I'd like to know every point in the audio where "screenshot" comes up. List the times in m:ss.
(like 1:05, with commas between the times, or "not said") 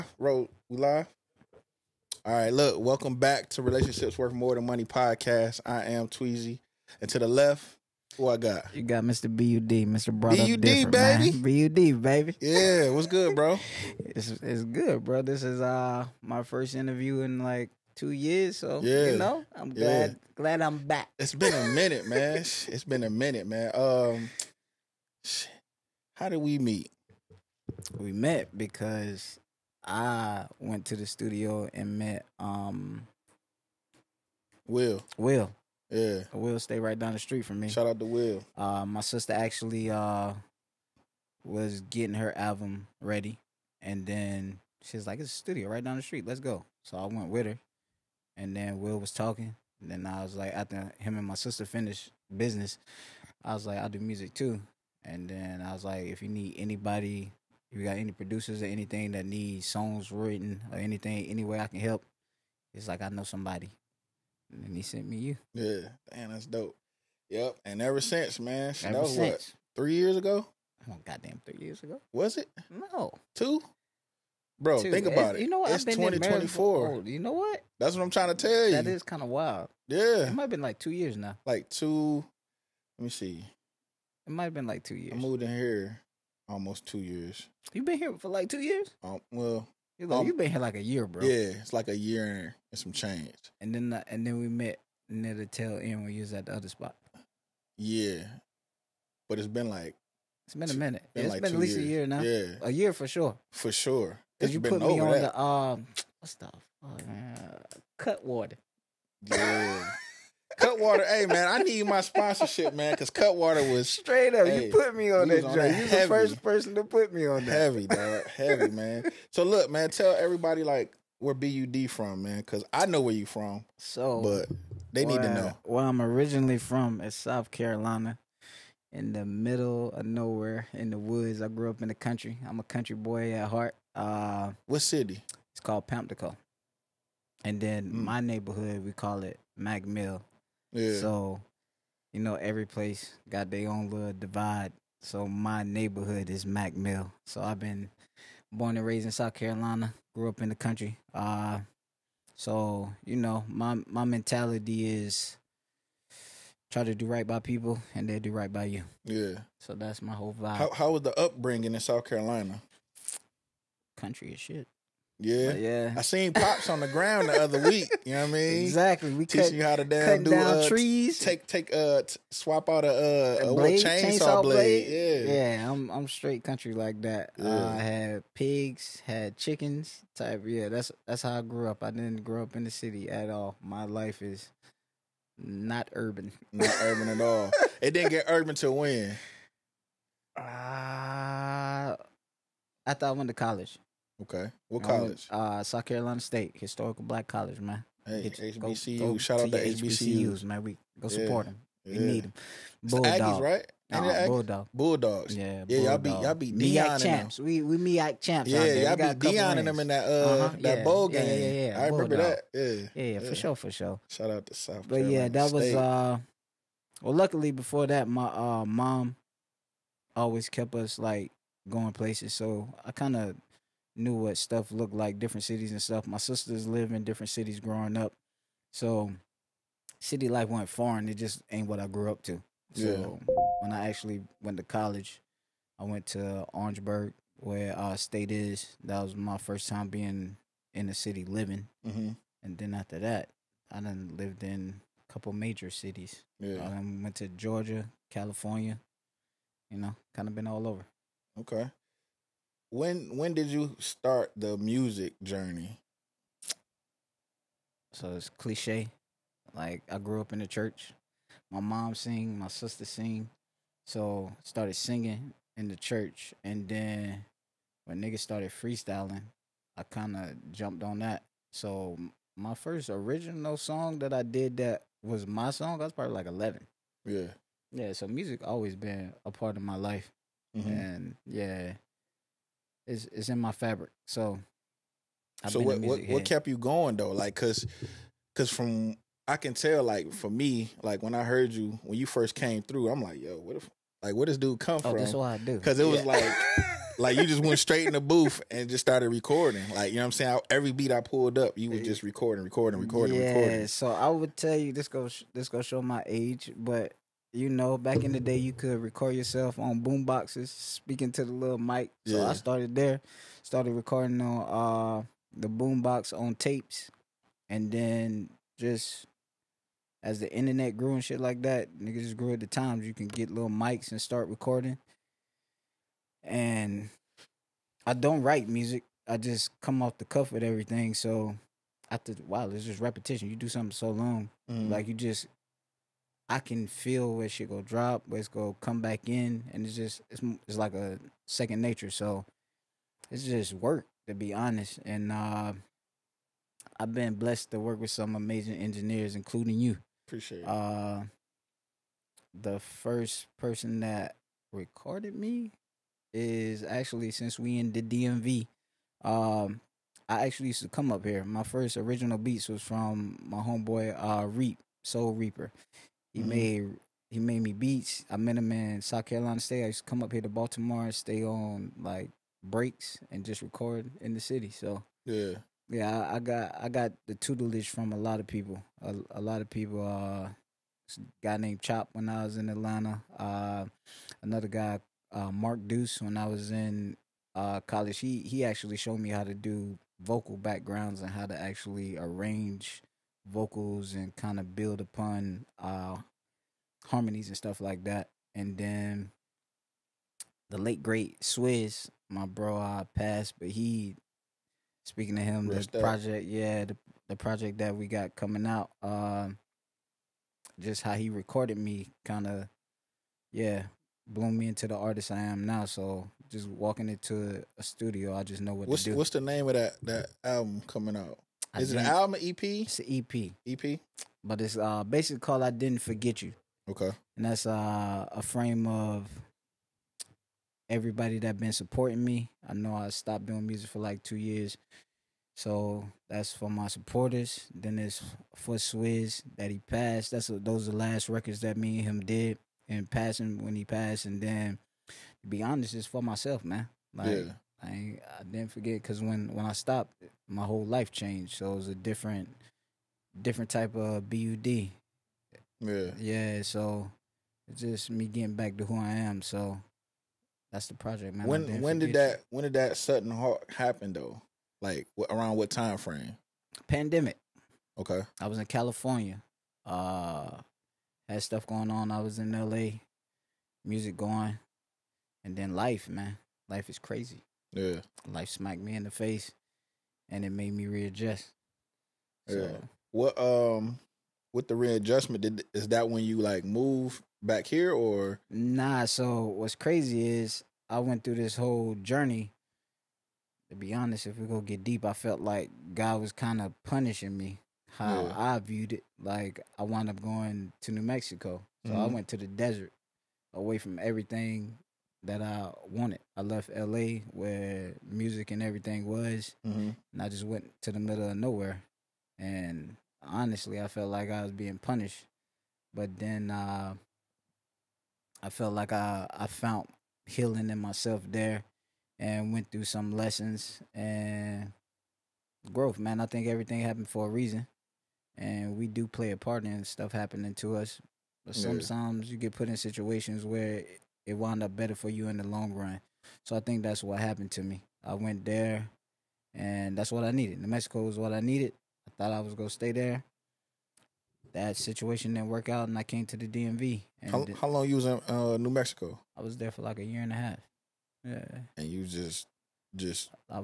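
not said.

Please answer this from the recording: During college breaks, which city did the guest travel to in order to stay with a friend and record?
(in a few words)
Baltimore.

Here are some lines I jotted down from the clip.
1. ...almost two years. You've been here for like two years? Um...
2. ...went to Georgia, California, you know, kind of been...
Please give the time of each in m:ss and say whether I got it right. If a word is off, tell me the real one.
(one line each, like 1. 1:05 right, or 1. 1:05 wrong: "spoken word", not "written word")
1. 1:26 right
2. 4:07 right.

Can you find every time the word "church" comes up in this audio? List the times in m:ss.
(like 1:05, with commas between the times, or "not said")
4:20, 4:25.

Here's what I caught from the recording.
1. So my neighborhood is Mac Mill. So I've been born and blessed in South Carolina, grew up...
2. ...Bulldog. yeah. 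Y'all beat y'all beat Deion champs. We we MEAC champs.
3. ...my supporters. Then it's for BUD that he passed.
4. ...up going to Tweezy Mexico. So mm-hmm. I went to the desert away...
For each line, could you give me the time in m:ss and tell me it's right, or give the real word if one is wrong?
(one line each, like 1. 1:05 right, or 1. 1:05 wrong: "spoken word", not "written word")
1. 2:25 wrong: "raised", not "blessed"
2. 3:25 right
3. 7:16 wrong: "Swizz", not "BUD"
4. 8:19 wrong: "New", not "Tweezy".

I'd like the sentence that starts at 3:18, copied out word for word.
Go, go Shout out to HBCUs, man.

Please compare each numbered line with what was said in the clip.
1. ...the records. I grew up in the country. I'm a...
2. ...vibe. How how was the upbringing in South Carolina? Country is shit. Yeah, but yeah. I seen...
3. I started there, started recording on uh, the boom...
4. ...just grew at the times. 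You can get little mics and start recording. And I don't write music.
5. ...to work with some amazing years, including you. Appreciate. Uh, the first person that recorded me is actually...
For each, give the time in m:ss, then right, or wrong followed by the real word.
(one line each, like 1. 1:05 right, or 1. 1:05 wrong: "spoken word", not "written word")
1. 2:10 wrong: "woods", not "records"
2. 2:40 right
3. 5:12 right
4. 5:22 right
5. 5:47 wrong: "engineers", not "years".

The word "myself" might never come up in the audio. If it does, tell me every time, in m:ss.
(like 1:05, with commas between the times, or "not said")
7:26, 8:40.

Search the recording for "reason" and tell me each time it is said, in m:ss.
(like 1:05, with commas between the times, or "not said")
8:47.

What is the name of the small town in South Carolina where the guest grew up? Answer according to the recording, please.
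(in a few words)
Pamplico.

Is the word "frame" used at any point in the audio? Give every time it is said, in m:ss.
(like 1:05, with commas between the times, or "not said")
7:08, 7:45.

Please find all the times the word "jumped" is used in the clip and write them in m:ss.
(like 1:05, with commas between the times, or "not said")
4:30.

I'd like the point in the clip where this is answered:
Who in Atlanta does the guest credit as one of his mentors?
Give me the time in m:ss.
6:21.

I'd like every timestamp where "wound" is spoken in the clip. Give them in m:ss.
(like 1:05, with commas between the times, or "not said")
8:19, 8:54.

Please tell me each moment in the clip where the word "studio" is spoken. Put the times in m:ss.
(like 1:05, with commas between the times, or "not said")
0:31, 0:45, 6:57.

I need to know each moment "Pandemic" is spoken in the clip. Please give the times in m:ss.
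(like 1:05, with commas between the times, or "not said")
7:46.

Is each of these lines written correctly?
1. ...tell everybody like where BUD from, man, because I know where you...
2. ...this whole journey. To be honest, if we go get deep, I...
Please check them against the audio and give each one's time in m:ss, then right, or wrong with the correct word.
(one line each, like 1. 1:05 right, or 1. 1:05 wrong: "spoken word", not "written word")
1. 1:59 right
2. 8:11 right.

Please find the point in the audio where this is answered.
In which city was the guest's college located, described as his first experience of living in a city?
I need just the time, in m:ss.
3:56.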